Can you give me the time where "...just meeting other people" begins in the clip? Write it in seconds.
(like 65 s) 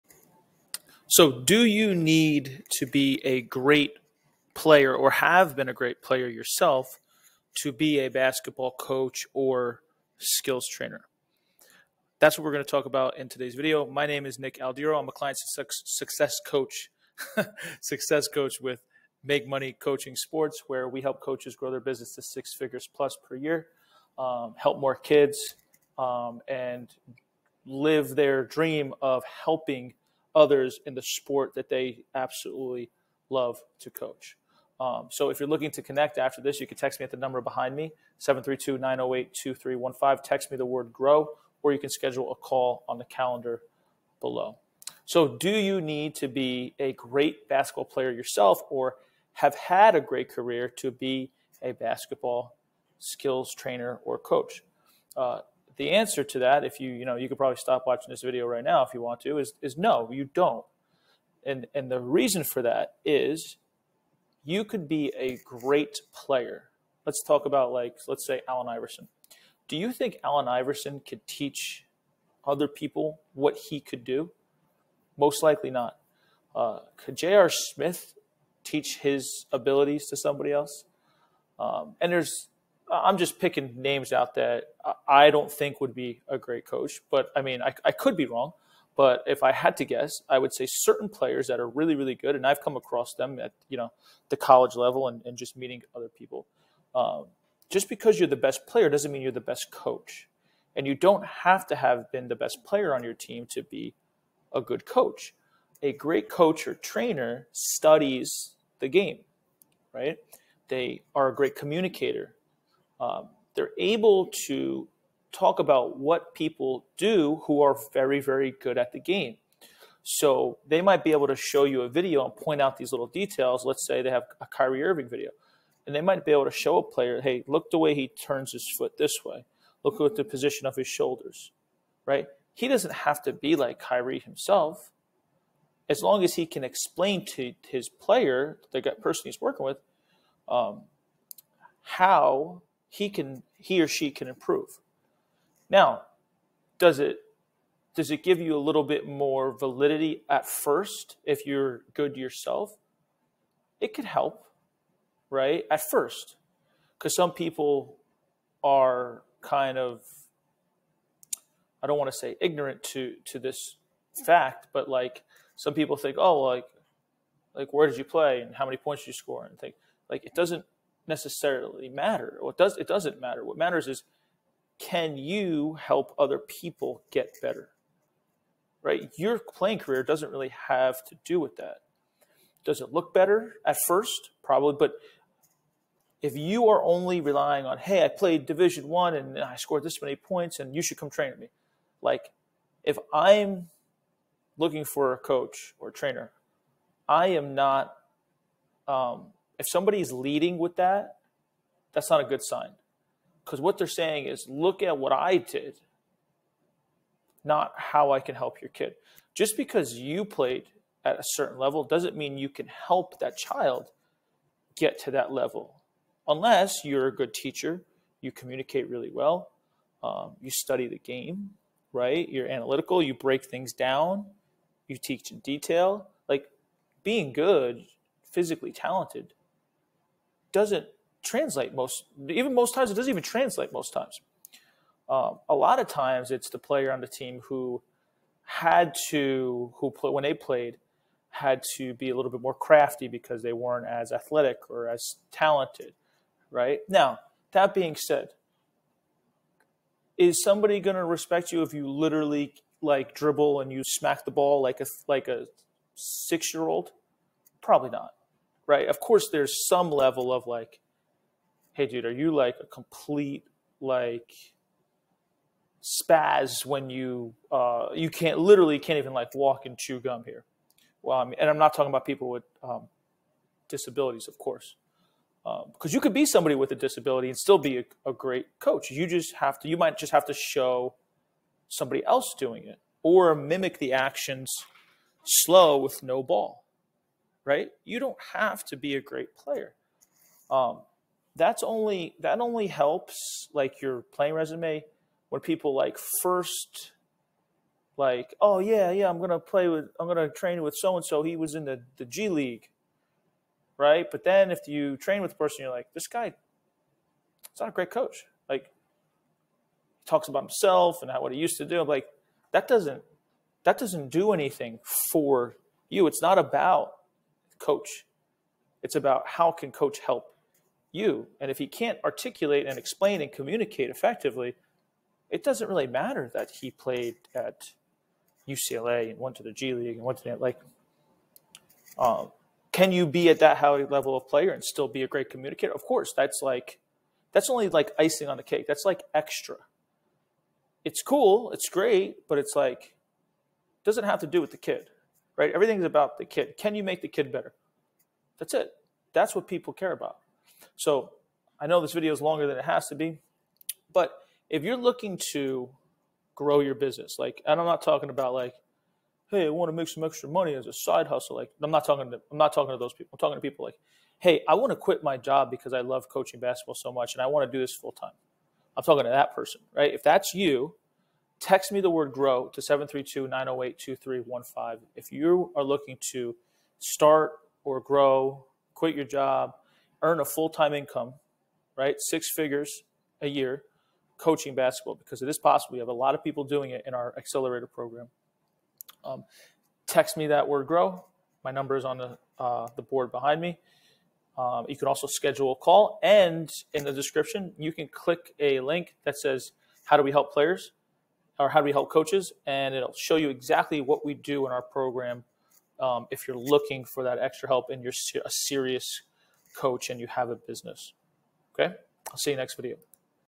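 95 s.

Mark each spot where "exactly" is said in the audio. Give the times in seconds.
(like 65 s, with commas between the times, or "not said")
403 s.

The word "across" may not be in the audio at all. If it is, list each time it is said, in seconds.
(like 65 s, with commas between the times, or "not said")
92 s.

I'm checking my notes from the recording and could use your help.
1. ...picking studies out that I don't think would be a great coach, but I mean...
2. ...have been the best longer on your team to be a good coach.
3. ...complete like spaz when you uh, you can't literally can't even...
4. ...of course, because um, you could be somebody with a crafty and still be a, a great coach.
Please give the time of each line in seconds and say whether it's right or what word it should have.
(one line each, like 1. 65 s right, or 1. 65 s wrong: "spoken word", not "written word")
1. 83 s wrong: "names", not "studies"
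2. 101 s wrong: "player", not "longer"
3. 262 s right
4. 274 s wrong: "disability", not "crafty".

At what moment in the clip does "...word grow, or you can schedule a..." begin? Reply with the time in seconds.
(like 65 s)
40 s.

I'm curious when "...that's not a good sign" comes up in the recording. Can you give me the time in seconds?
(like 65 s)
201 s.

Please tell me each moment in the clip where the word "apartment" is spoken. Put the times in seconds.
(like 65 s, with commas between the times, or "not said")
not said.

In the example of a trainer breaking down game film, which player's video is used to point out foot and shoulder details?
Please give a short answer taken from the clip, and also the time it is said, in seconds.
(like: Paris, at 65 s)
Kyrie Irving, at 124 s.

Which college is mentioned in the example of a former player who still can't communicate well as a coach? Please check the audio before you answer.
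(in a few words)
UCLA.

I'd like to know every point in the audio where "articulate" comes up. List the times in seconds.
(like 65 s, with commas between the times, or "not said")
322 s.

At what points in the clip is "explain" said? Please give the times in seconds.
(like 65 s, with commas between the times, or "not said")
136 s, 322 s.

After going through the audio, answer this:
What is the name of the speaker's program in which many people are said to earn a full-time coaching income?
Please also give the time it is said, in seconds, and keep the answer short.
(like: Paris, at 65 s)
accelerator program, at 387 s.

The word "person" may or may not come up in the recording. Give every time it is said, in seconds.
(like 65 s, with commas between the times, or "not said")
139 s, 305 s, 369 s.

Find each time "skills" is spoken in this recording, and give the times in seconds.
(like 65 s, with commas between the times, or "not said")
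10 s, 52 s.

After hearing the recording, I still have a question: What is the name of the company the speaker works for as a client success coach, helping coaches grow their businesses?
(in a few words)
Make Money Coaching Sports.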